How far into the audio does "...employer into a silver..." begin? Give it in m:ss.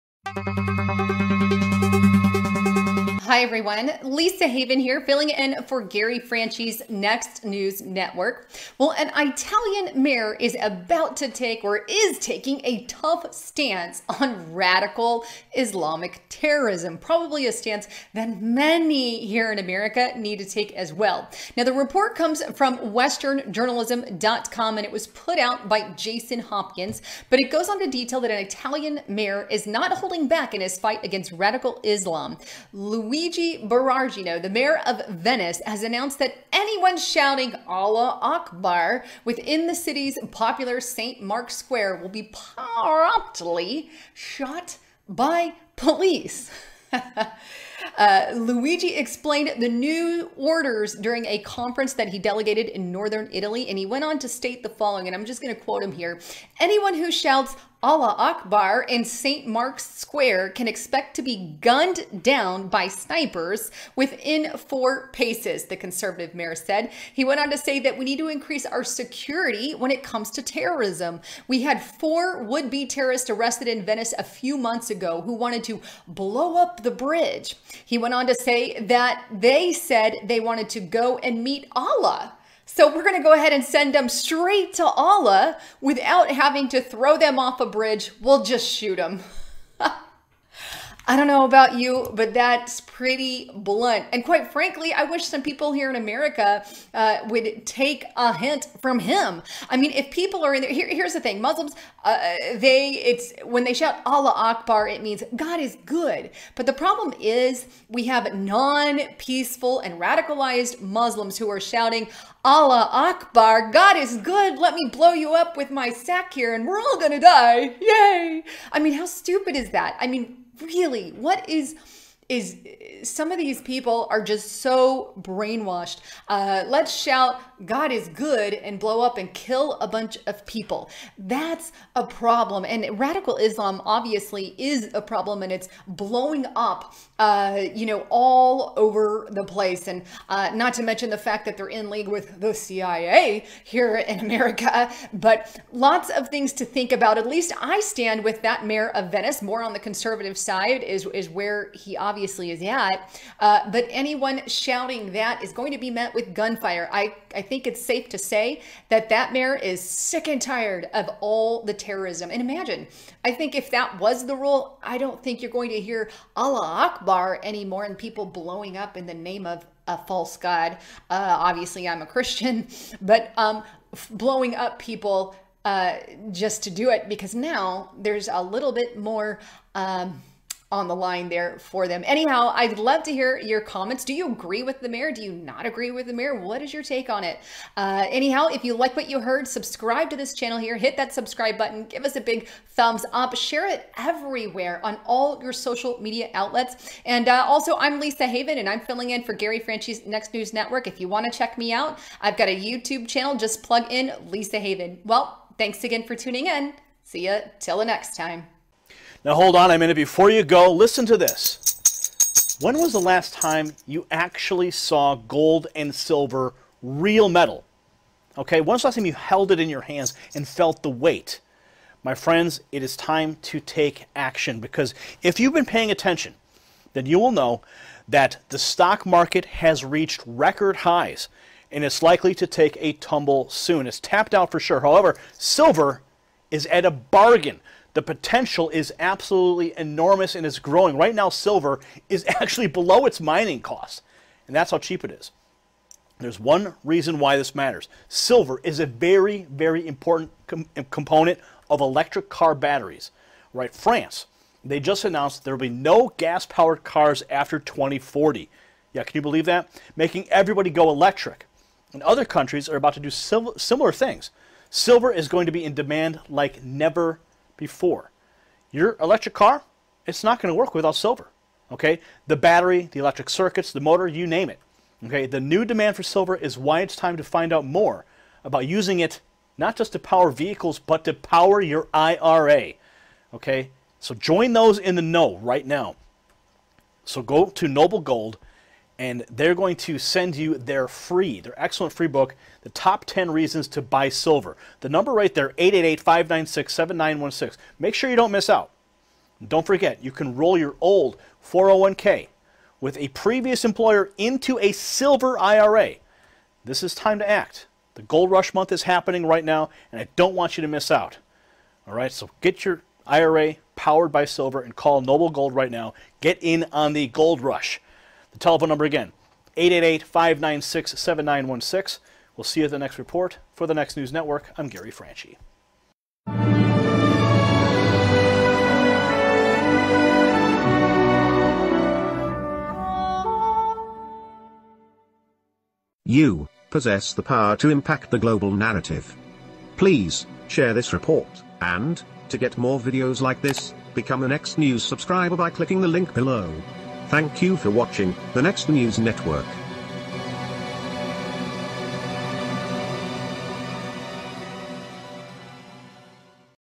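5:03.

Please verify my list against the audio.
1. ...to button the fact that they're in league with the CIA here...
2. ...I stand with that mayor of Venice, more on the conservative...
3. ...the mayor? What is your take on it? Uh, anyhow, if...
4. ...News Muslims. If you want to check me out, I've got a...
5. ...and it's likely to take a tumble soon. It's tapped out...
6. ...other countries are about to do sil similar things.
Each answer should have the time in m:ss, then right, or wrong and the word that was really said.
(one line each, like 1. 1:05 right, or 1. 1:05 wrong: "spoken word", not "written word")
1. 2:20 wrong: "mention", not "button"
2. 2:27 right
3. 3:06 right
4. 3:20 wrong: "Network", not "Muslims"
5. 3:51 right
6. 4:22 right.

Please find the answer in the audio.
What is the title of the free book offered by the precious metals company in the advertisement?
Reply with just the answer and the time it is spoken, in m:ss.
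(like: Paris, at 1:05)
The Top 10 Reasons to Buy Silver, at 4:52.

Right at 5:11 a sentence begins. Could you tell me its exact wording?
All right, so get your IRA powered by silver and call Noble Gold right now.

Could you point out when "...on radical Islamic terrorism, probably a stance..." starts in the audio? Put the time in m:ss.
0:14.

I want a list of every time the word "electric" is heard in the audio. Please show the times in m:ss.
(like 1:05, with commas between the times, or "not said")
4:11, 4:20, 4:28, 4:32.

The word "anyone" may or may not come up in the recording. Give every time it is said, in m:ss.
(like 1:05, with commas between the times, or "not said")
0:36, 0:56, 2:33.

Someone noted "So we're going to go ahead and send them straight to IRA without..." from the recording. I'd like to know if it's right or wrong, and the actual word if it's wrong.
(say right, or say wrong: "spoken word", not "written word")
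wrong: "Allah", not "IRA".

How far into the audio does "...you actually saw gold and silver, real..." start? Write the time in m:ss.
3:33.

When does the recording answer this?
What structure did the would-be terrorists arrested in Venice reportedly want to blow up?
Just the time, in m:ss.
1:16.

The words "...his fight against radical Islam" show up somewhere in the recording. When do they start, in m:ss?
0:30.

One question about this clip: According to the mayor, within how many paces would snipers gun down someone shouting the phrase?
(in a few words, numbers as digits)
4.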